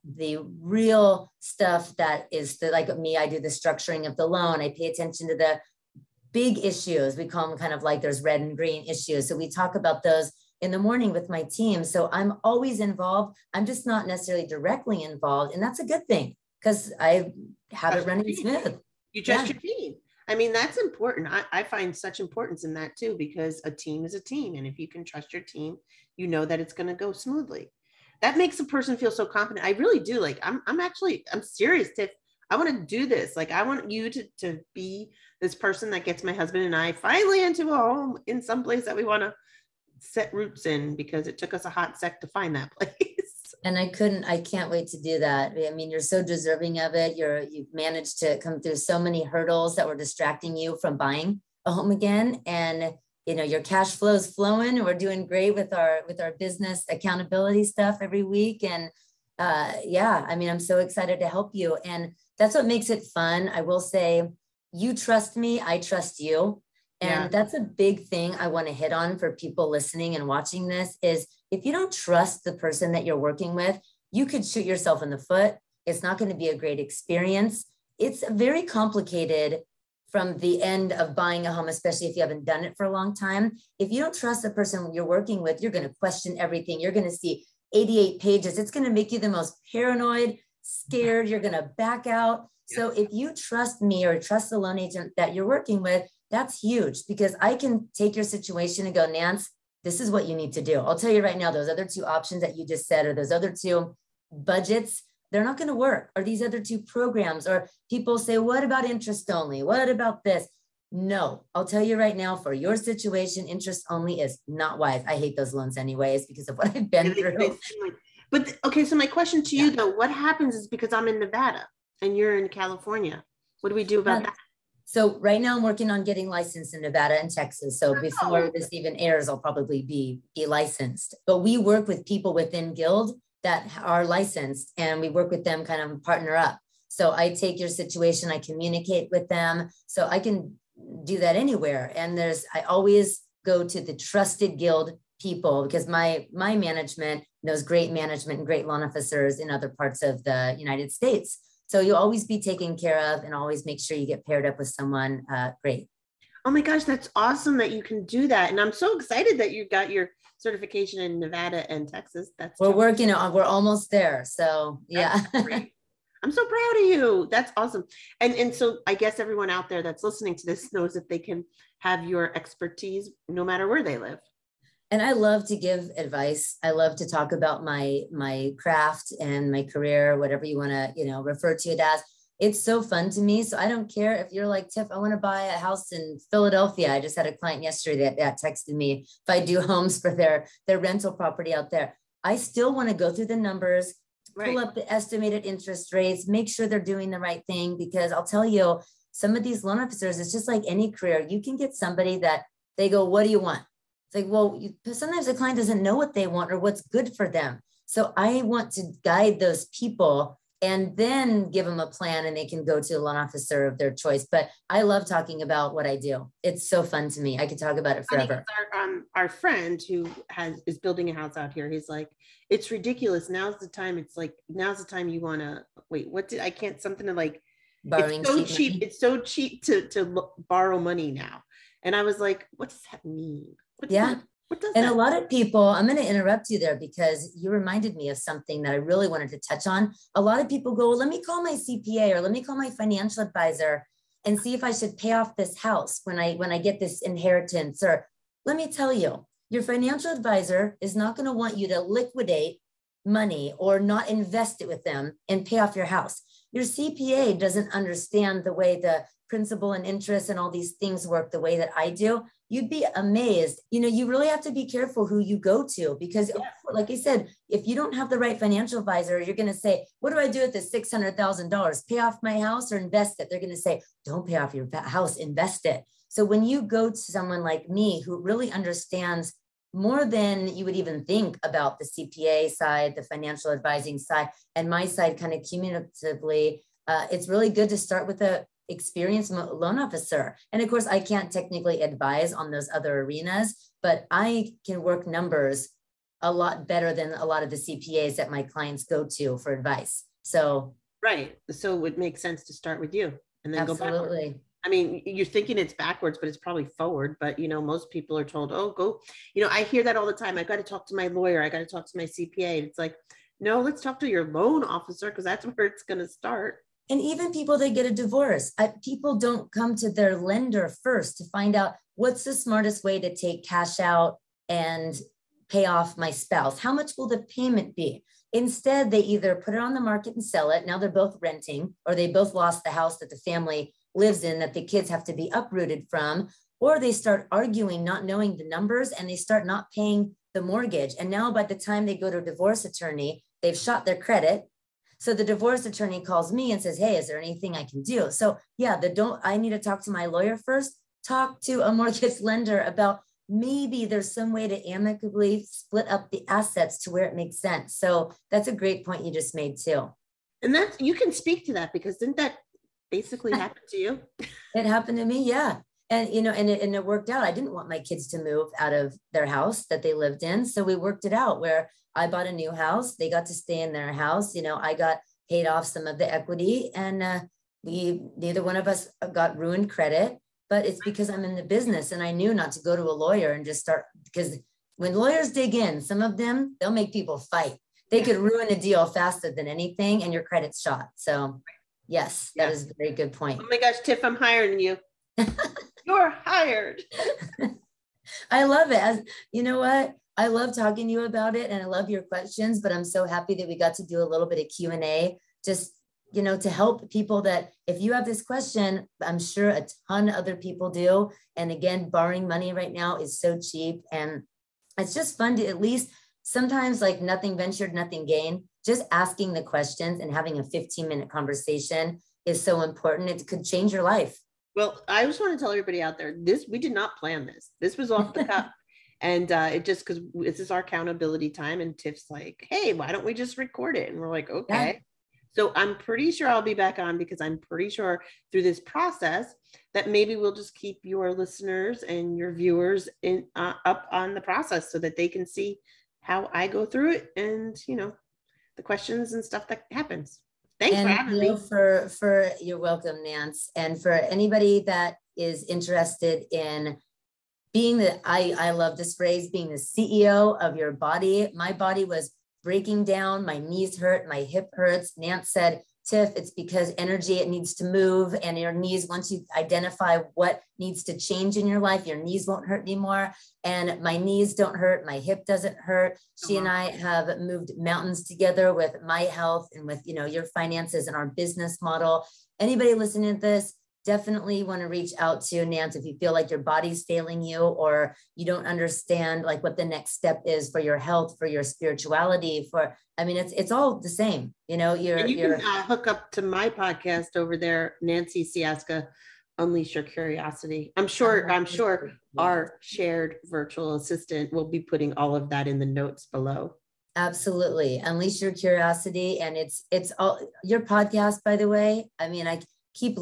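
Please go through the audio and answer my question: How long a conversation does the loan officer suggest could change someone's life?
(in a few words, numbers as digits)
15 minutes.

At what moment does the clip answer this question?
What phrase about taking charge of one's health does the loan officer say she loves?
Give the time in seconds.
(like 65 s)
459 s.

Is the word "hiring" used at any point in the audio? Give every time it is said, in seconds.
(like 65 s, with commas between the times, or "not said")
394 s.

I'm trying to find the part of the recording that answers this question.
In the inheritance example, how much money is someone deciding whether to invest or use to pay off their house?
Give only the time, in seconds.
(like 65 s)
270 s.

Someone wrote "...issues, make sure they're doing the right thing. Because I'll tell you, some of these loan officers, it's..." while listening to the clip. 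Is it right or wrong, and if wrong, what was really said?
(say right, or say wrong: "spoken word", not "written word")
wrong: "rates", not "issues".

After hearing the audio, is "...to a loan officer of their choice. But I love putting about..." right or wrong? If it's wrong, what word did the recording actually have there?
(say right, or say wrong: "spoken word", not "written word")
wrong: "talking", not "putting".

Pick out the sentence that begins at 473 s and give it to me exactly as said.
And my knees don't hurt, my hip doesn't hurt.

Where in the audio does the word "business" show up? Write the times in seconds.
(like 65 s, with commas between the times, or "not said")
56 s, 381 s, 481 s.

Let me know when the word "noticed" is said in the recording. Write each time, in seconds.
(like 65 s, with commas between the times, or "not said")
not said.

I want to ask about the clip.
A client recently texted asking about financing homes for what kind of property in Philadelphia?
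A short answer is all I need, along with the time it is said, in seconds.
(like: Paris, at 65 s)
Rental property, at 190 s.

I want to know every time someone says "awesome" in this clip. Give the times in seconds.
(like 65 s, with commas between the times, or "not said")
157 s, 167 s.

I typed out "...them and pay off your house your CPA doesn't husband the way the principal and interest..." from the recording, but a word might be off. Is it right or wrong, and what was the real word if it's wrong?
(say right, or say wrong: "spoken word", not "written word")
wrong: "understand", not "husband".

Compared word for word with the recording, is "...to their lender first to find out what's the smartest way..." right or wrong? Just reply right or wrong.
right.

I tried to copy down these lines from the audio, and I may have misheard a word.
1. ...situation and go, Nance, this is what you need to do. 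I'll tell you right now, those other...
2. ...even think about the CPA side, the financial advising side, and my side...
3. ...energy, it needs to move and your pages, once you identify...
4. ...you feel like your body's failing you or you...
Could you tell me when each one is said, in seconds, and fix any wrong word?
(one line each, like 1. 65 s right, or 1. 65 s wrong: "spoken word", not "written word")
1. 98 s right
2. 280 s right
3. 466 s wrong: "knees", not "pages"
4. 485 s right.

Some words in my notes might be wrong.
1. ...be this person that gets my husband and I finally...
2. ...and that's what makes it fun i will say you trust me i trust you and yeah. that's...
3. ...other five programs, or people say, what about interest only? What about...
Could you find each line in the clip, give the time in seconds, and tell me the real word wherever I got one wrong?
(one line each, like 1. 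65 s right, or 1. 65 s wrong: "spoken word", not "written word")
1. 34 s right
2. 61 s right
3. 106 s wrong: "two", not "five".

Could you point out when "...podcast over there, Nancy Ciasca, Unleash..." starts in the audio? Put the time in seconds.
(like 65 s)
496 s.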